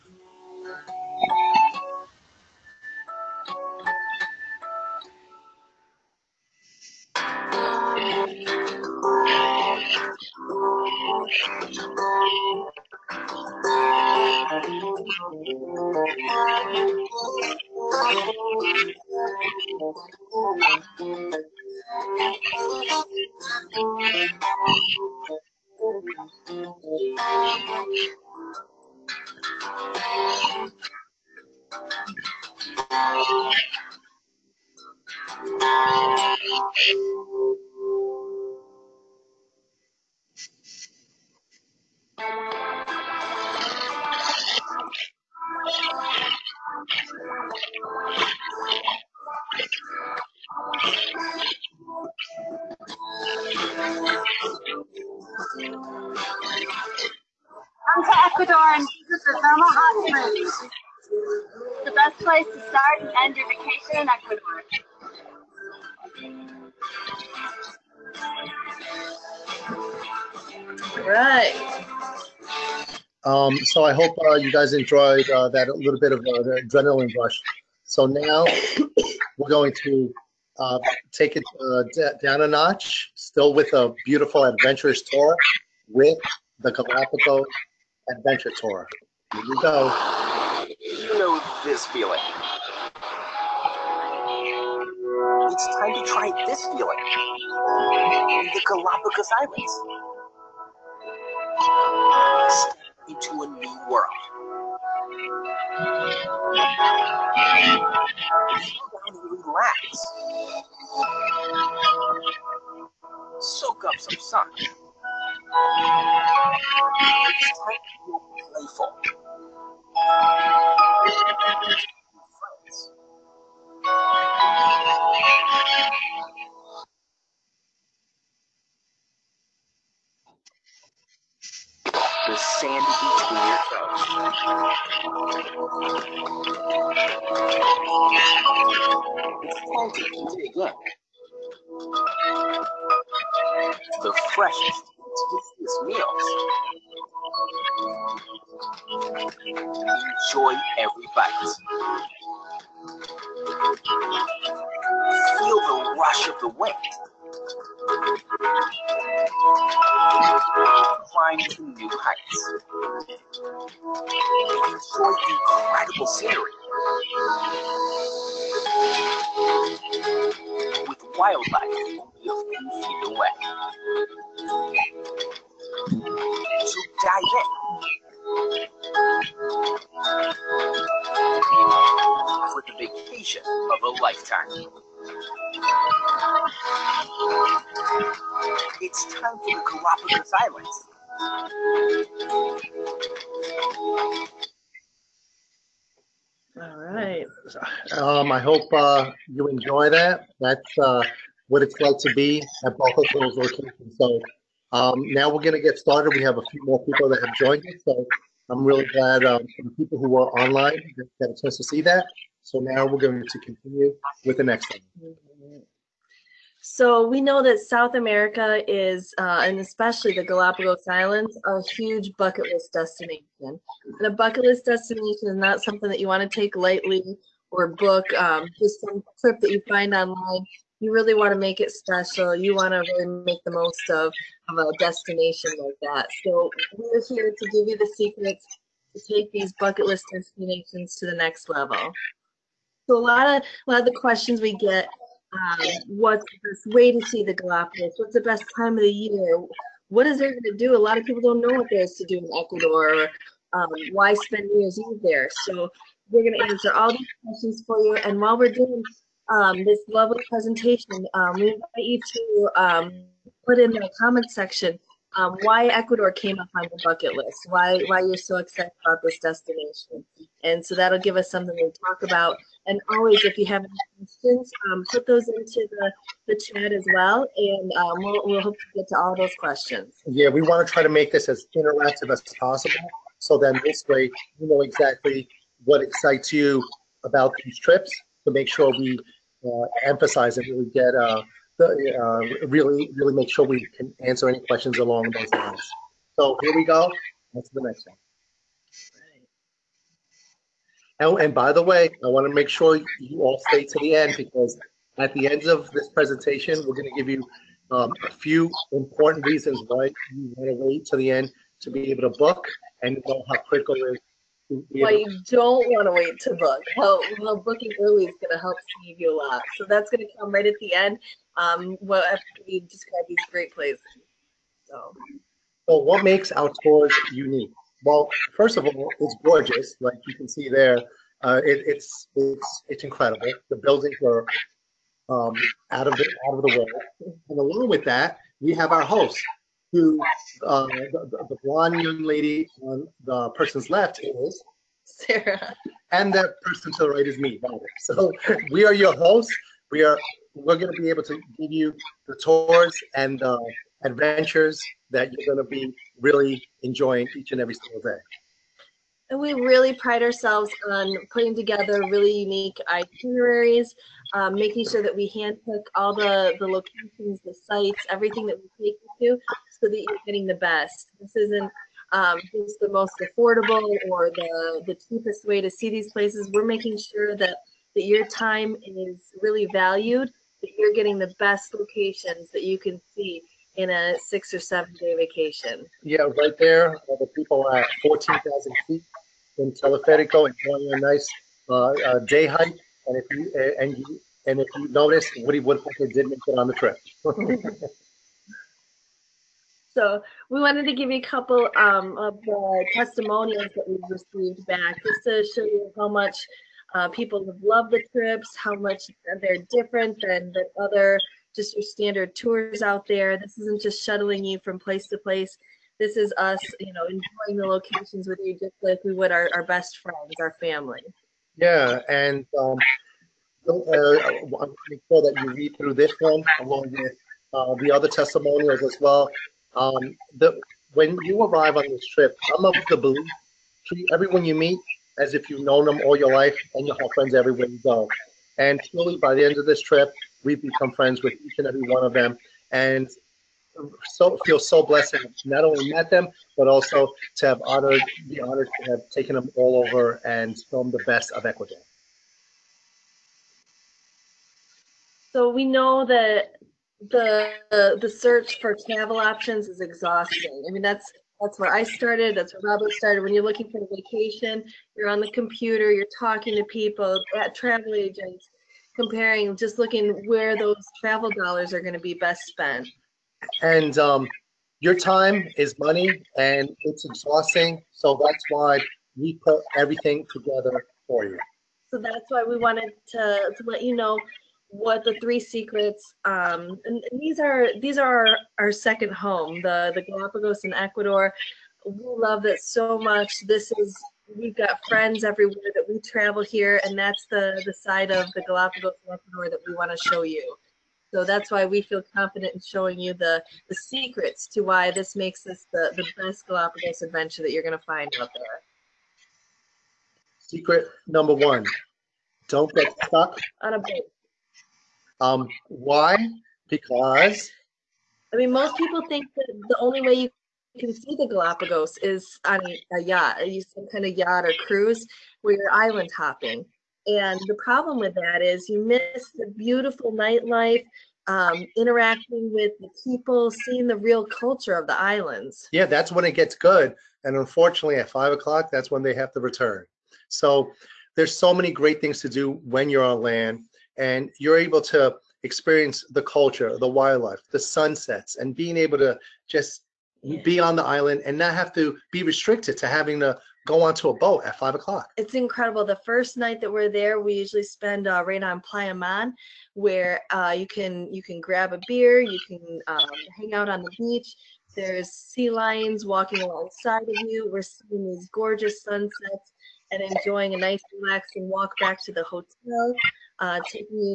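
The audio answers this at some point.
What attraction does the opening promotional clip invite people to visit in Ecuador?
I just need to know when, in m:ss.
0:59.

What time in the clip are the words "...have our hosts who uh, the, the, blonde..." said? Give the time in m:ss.
5:38.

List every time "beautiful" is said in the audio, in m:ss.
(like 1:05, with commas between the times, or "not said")
1:24, 8:49.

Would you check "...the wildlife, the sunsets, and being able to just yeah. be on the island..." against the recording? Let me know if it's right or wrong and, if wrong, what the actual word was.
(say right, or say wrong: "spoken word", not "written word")
right.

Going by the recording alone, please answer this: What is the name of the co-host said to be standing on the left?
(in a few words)
Sarah.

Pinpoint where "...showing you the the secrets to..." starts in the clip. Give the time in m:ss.
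8:22.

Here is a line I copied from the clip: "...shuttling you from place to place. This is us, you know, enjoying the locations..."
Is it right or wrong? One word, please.
right.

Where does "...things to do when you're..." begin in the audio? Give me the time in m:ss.
9:01.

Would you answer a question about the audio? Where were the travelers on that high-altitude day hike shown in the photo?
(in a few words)
Teleferico.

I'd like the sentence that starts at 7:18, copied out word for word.
And truly, by the end of this trip, we've become friends with each and every one of them.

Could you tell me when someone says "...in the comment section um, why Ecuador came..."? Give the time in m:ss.
4:23.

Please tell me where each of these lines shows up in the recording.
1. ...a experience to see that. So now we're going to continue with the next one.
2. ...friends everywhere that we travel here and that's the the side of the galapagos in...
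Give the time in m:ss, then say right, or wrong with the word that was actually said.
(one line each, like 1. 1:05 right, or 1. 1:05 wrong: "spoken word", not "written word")
1. 3:31 wrong: "chance", not "experience"
2. 8:14 right.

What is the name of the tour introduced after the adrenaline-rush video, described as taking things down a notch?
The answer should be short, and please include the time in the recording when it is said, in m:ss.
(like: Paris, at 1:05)
Galapagos Adventure Tour, at 1:26.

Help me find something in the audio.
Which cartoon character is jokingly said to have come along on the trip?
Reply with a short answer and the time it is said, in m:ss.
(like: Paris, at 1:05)
Woody Woodpecker, at 6:35.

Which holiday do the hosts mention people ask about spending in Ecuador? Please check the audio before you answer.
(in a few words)
New Year's Eve.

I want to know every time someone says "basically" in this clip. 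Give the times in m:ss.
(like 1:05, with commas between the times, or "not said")
not said.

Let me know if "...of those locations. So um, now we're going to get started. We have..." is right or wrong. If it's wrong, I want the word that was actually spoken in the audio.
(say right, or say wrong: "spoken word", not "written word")
right.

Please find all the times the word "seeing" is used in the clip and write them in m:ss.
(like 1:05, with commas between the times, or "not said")
8:53, 9:27.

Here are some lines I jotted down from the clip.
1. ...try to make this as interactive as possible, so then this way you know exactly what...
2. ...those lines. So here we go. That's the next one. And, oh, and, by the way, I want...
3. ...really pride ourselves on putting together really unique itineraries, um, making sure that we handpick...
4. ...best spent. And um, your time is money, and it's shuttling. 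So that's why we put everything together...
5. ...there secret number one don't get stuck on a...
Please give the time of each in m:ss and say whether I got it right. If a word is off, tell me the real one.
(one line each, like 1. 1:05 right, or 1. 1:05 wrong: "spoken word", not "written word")
1. 4:40 right
2. 4:55 right
3. 5:59 right
4. 7:51 wrong: "exhausting", not "shuttling"
5. 8:28 right.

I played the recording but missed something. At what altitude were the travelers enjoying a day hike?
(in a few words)
14,000 feet.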